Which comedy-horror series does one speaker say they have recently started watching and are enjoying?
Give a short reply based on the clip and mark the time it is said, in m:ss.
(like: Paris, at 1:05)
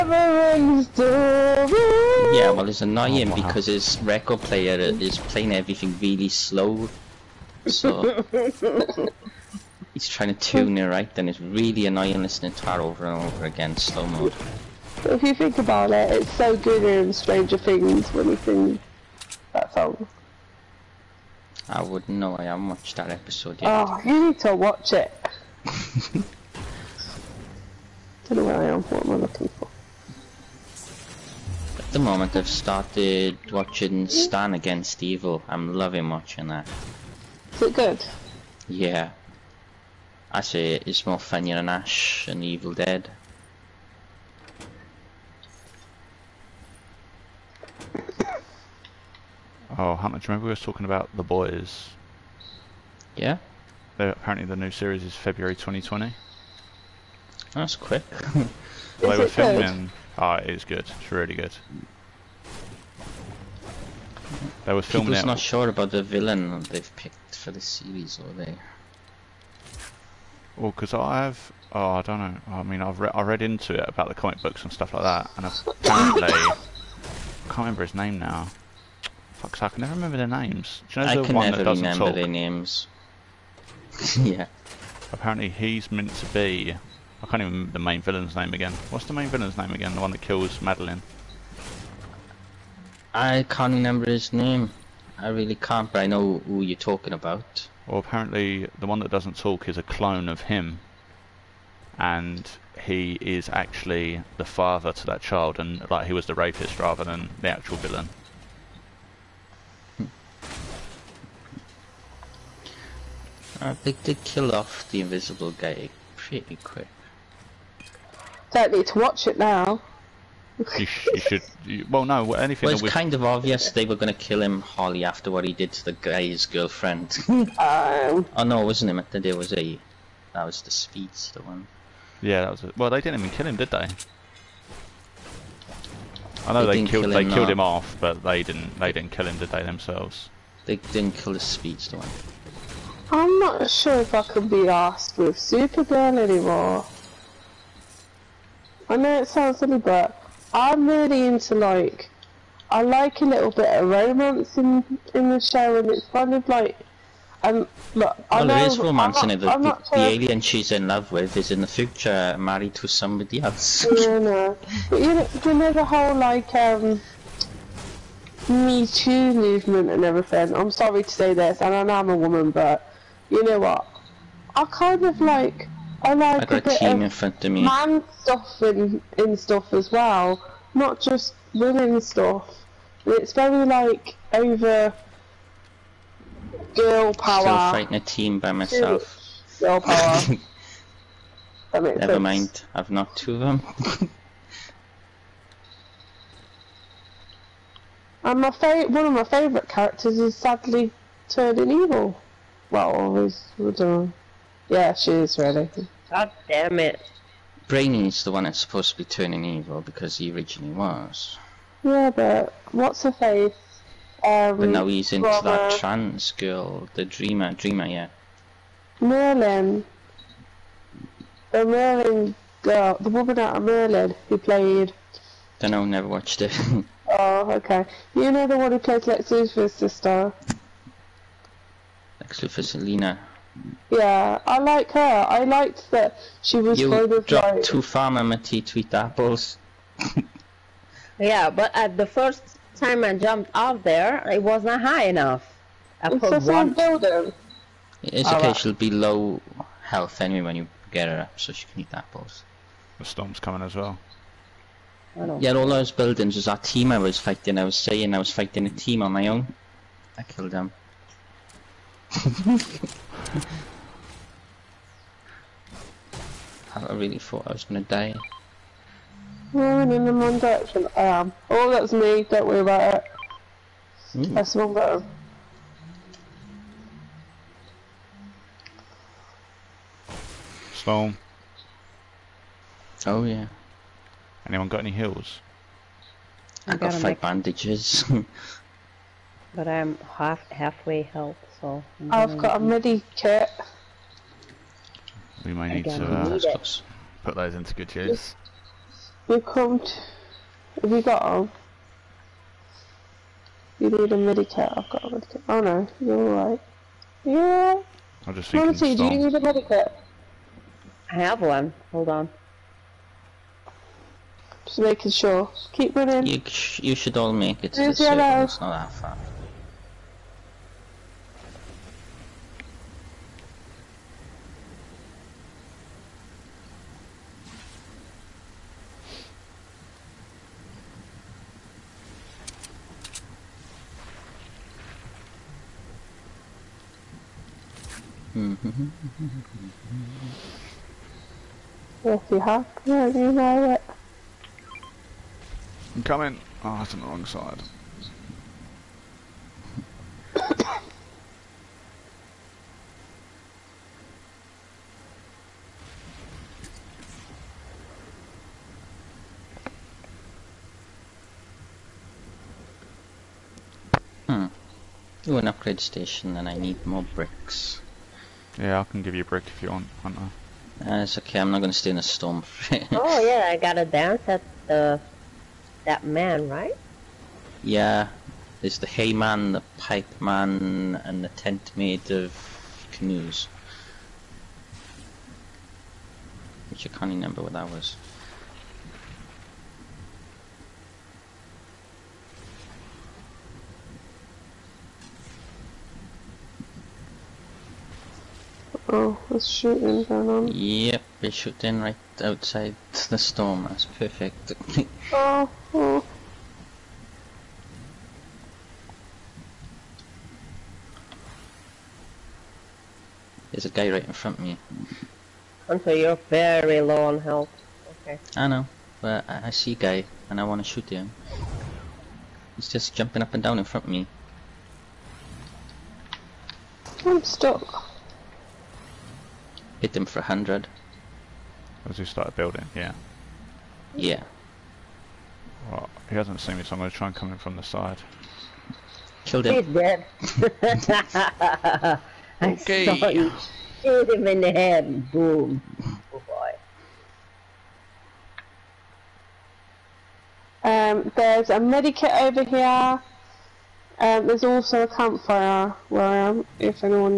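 Stan Against Evil, at 0:34.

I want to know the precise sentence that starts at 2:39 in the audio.
The, the, the, alien she's in love with is in the future married to somebody else.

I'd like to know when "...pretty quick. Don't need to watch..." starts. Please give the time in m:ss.
1:56.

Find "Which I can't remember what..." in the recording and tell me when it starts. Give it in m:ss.
6:26.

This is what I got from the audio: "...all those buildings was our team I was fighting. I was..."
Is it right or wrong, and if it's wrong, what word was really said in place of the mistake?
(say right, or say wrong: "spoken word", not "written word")
right.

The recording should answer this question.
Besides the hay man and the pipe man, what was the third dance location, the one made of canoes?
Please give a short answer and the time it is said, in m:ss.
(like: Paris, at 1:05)
The tent, at 6:21.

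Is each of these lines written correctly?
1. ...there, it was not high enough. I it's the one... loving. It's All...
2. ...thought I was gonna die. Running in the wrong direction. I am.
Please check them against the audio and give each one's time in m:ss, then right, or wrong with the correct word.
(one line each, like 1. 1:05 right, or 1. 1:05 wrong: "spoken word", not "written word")
1. 4:03 wrong: "building", not "loving"
2. 4:27 right.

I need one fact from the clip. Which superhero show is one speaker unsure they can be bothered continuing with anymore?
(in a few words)
Supergirl.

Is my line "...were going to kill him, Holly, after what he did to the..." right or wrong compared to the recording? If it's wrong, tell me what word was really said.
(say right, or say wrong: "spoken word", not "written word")
right.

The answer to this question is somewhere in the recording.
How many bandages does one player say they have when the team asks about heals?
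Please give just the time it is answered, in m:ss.
4:46.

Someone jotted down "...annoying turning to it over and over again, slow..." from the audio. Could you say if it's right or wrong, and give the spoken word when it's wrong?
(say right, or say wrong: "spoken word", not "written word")
wrong: "listening", not "turning".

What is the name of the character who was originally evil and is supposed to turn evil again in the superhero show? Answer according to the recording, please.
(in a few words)
Brainy.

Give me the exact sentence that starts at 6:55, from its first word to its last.
Hunter, you're very low on health.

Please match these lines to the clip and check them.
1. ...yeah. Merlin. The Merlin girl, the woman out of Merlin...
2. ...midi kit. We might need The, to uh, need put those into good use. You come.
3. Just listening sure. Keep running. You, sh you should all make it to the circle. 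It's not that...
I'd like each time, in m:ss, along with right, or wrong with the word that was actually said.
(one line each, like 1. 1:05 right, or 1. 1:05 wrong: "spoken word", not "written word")
1. 3:37 right
2. 4:52 wrong: "Again", not "The"
3. 5:14 wrong: "making", not "listening".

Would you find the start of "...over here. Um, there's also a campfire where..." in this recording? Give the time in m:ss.
7:32.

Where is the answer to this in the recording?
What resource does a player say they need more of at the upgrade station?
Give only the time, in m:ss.
6:07.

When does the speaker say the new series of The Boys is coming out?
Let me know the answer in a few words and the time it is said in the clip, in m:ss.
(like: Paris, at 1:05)
February 2020, at 0:55.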